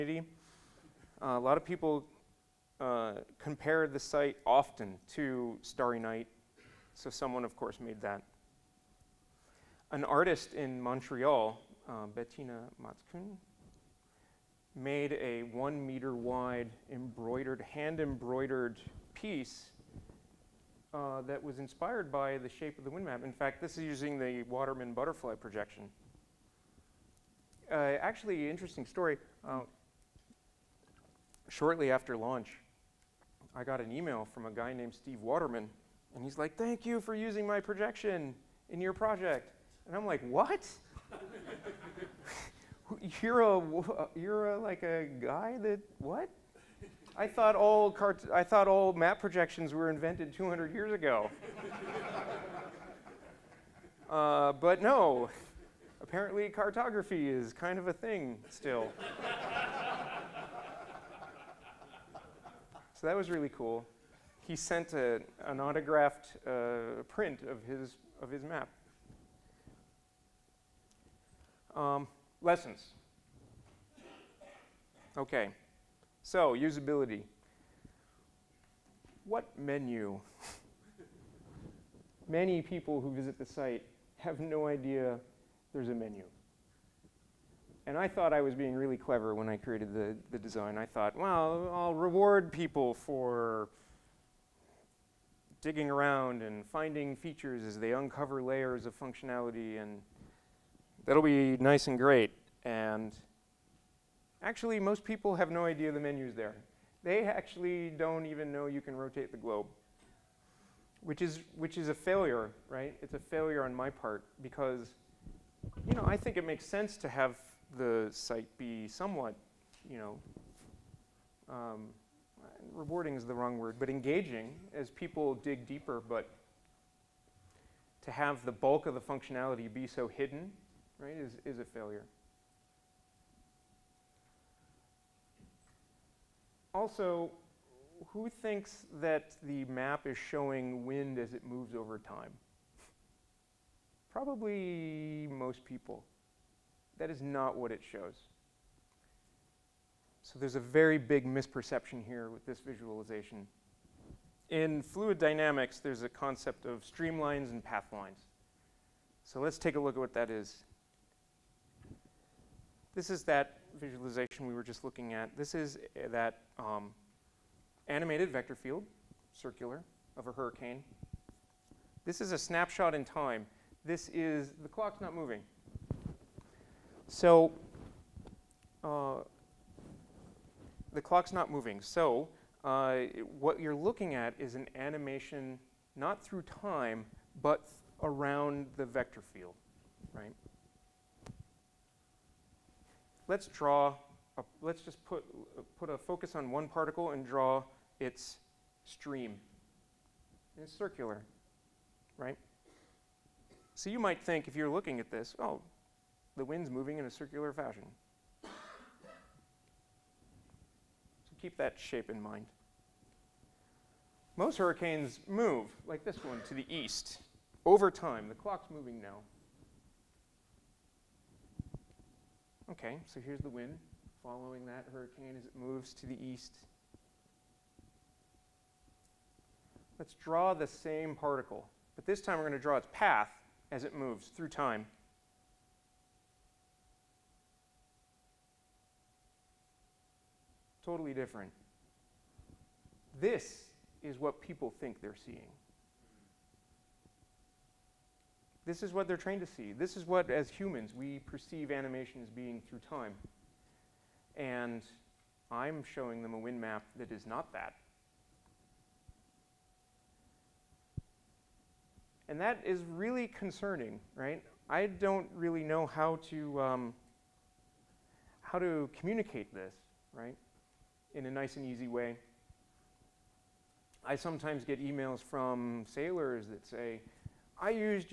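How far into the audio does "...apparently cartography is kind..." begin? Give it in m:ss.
0:56.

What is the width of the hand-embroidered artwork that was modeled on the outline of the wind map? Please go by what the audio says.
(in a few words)
1 meter.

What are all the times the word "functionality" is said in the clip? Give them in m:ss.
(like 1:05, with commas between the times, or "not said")
1:38, 2:08.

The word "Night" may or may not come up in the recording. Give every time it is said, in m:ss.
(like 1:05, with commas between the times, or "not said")
0:05.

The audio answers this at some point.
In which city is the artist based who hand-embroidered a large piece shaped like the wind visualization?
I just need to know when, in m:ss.
0:10.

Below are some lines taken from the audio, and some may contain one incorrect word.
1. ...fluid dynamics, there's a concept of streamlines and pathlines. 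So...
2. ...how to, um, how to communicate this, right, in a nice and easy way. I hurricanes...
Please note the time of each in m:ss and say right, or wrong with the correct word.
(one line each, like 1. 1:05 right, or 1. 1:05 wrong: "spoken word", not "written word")
1. 2:34 right
2. 4:25 wrong: "sometimes", not "hurricanes".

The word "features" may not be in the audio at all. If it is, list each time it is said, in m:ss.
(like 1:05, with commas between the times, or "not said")
1:37.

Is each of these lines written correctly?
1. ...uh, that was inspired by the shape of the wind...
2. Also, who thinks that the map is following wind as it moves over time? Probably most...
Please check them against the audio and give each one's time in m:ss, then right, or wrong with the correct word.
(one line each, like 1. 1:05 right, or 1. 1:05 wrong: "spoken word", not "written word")
1. 0:20 right
2. 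2:16 wrong: "showing", not "following".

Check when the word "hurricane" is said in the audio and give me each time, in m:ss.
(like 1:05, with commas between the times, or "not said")
2:50, 3:34, 3:44.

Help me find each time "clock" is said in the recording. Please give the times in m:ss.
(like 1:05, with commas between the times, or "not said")
2:54, 3:00, 3:38.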